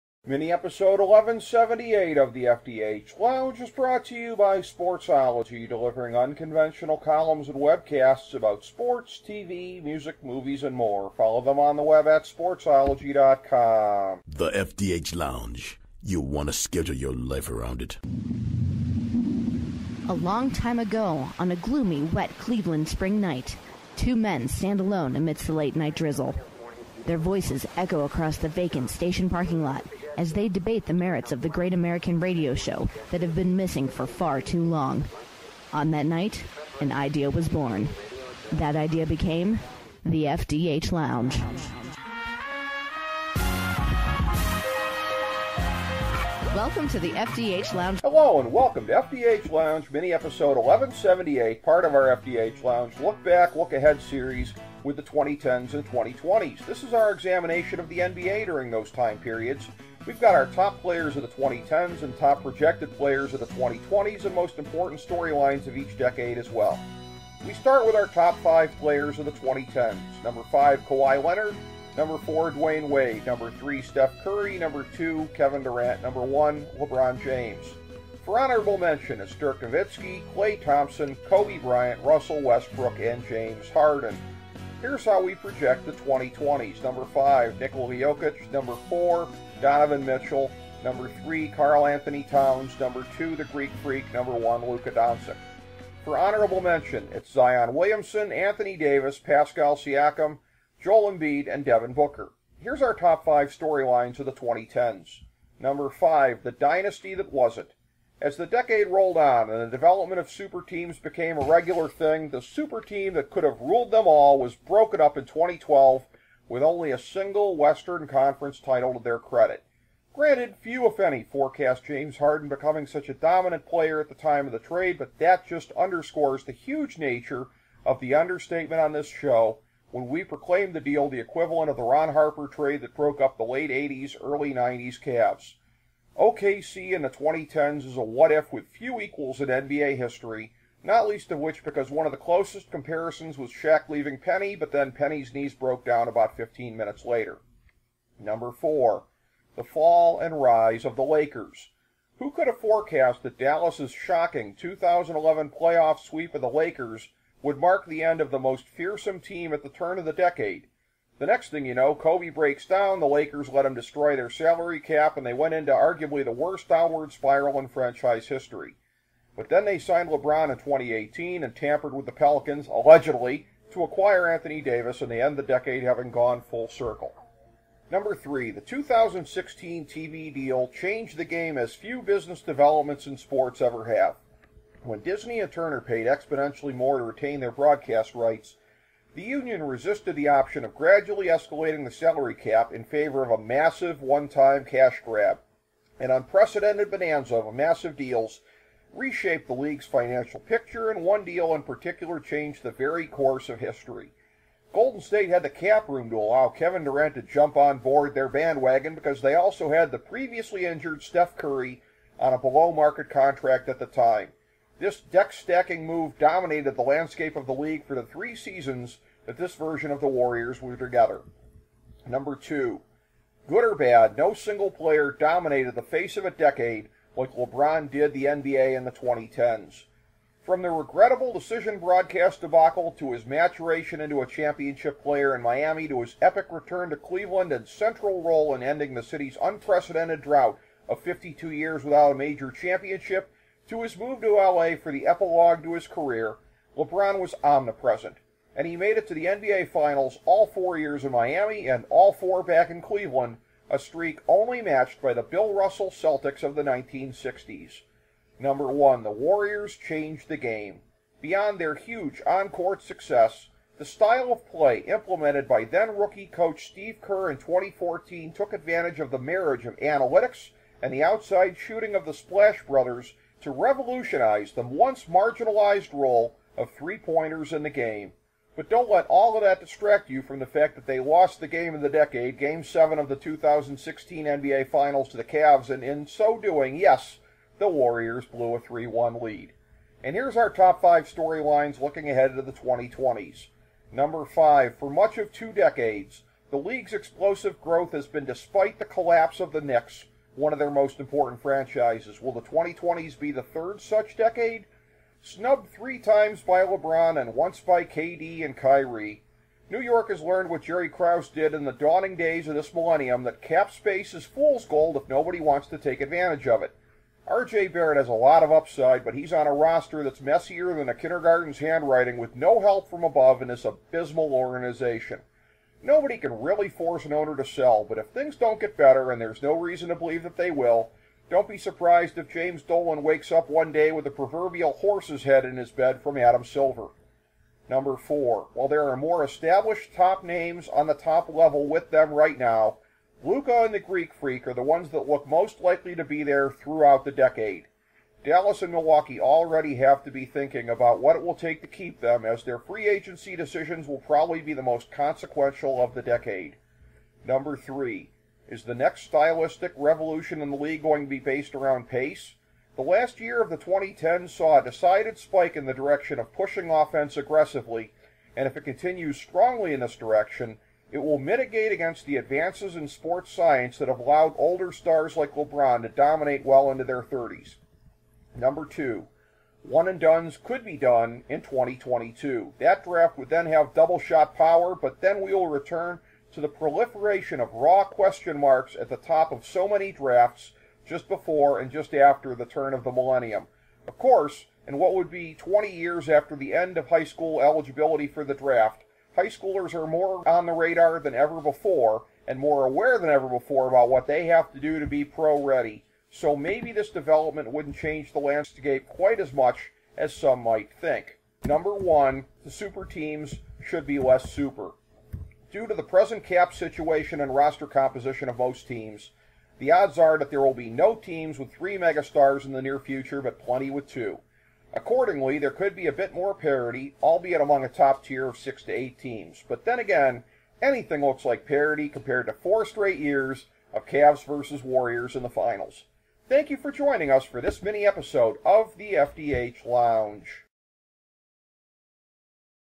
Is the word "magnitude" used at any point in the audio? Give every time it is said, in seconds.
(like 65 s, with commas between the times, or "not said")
not said.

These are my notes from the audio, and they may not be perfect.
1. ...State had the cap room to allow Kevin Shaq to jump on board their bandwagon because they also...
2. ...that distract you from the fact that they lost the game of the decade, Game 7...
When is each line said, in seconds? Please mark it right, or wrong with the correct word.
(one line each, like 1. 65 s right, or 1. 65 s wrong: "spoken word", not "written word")
1. 205 s wrong: "Durant", not "Shaq"
2. 279 s right.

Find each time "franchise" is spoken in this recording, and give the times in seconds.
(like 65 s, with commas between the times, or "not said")
167 s, 301 s.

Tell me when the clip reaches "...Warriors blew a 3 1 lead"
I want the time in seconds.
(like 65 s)
287 s.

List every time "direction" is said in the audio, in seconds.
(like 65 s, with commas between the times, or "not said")
365 s, 369 s.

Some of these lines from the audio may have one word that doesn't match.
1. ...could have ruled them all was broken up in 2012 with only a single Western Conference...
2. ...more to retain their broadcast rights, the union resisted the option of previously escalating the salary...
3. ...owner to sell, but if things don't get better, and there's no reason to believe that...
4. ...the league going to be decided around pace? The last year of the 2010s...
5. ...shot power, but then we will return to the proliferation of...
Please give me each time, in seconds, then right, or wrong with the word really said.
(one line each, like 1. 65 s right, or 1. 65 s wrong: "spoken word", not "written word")
1. 113 s right
2. 186 s wrong: "gradually", not "previously"
3. 327 s right
4. 360 s wrong: "based", not "decided"
5. 383 s right.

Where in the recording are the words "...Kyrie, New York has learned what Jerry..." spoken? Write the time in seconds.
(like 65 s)
308 s.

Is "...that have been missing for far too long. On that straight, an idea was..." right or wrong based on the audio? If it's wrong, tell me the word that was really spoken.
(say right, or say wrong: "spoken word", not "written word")
wrong: "night", not "straight".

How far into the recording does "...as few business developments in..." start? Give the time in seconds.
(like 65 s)
181 s.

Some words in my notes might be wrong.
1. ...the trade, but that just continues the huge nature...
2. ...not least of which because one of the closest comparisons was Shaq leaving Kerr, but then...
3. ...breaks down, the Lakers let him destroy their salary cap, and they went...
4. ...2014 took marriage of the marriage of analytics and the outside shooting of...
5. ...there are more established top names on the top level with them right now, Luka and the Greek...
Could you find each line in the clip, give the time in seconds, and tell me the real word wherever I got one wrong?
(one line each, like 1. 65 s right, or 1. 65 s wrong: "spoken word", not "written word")
1. 124 s wrong: "underscores", not "continues"
2. 140 s wrong: "Penny", not "Kerr"
3. 162 s right
4. 267 s wrong: "advantage", not "marriage"
5. 338 s right.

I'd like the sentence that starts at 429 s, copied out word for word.
But then again, anything looks like parity compared to four straight years of Cavs versus Warriors in the finals.